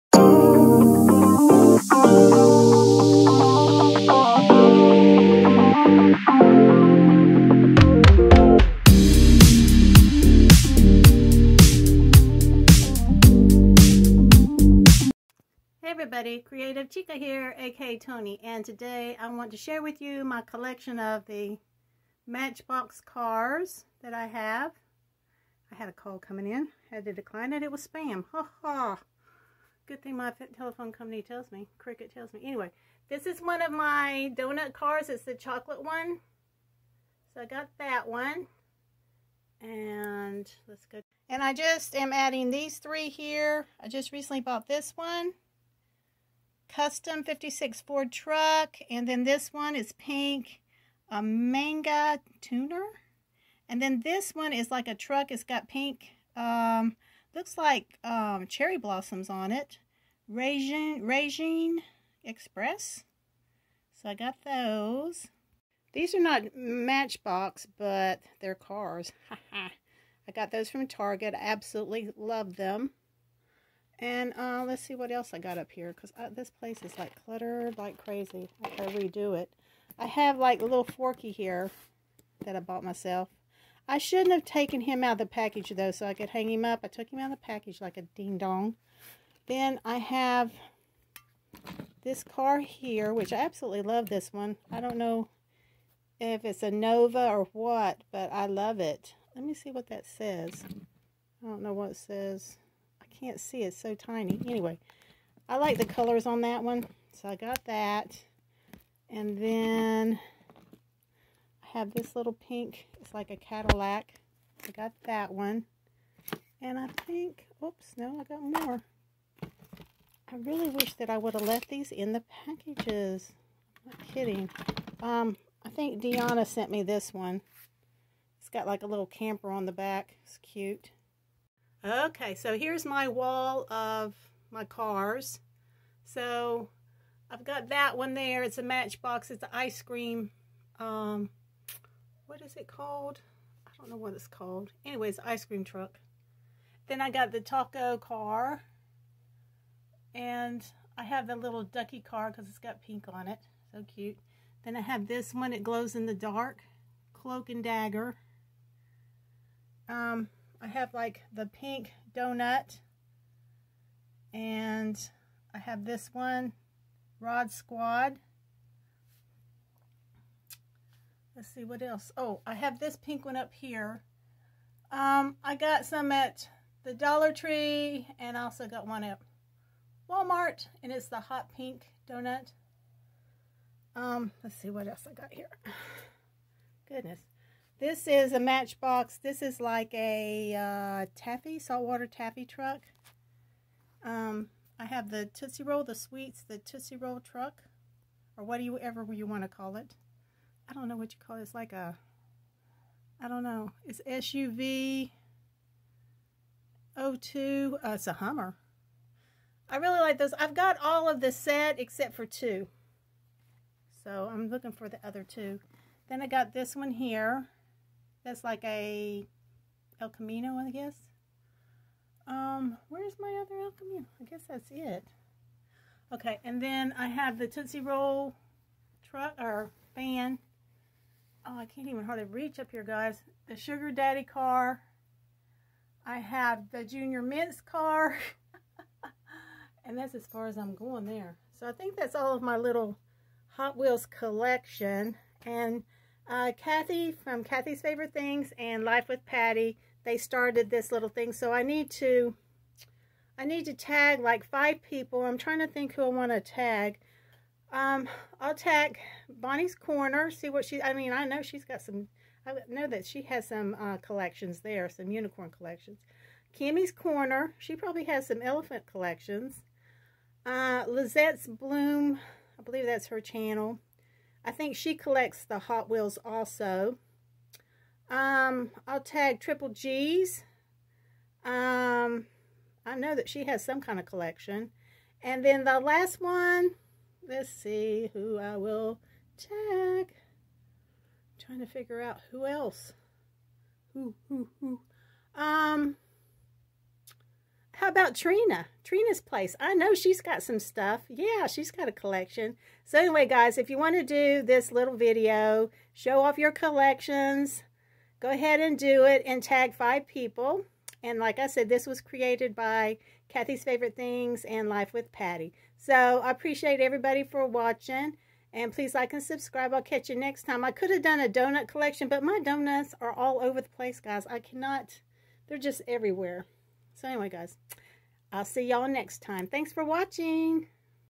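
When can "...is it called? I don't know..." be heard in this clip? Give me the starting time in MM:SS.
02:22.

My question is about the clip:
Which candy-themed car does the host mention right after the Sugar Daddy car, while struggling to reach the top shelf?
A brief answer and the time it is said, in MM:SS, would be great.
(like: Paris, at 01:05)
Junior Mints, at 03:56.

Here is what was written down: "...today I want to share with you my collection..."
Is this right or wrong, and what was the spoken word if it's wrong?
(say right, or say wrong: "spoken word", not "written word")
right.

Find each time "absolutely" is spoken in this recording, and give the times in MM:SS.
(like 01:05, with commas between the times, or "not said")
01:11, 01:33.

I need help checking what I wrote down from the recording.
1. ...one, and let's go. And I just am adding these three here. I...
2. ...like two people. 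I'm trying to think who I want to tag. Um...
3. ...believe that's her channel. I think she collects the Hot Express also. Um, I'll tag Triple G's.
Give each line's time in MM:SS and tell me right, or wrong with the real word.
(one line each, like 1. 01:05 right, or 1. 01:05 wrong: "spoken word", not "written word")
1. 00:38 right
2. 04:14 wrong: "five", not "two"
3. 04:32 wrong: "Wheels", not "Express".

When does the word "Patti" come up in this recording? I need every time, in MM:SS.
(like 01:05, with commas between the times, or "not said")
04:09, 05:15.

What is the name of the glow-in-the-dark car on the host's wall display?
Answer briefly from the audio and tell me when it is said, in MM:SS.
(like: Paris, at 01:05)
Cloak and dagger, at 02:37.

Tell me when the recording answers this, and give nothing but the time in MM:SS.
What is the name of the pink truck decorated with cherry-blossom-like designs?
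01:01.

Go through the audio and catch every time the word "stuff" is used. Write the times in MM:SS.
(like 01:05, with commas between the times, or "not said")
05:00.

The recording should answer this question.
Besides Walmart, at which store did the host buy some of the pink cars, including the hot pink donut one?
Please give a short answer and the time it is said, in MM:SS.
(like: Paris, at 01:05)
Dollar Tree, at 02:56.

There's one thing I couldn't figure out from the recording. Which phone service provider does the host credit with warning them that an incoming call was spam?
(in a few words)
Cricket.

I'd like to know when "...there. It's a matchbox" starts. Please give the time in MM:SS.
02:18.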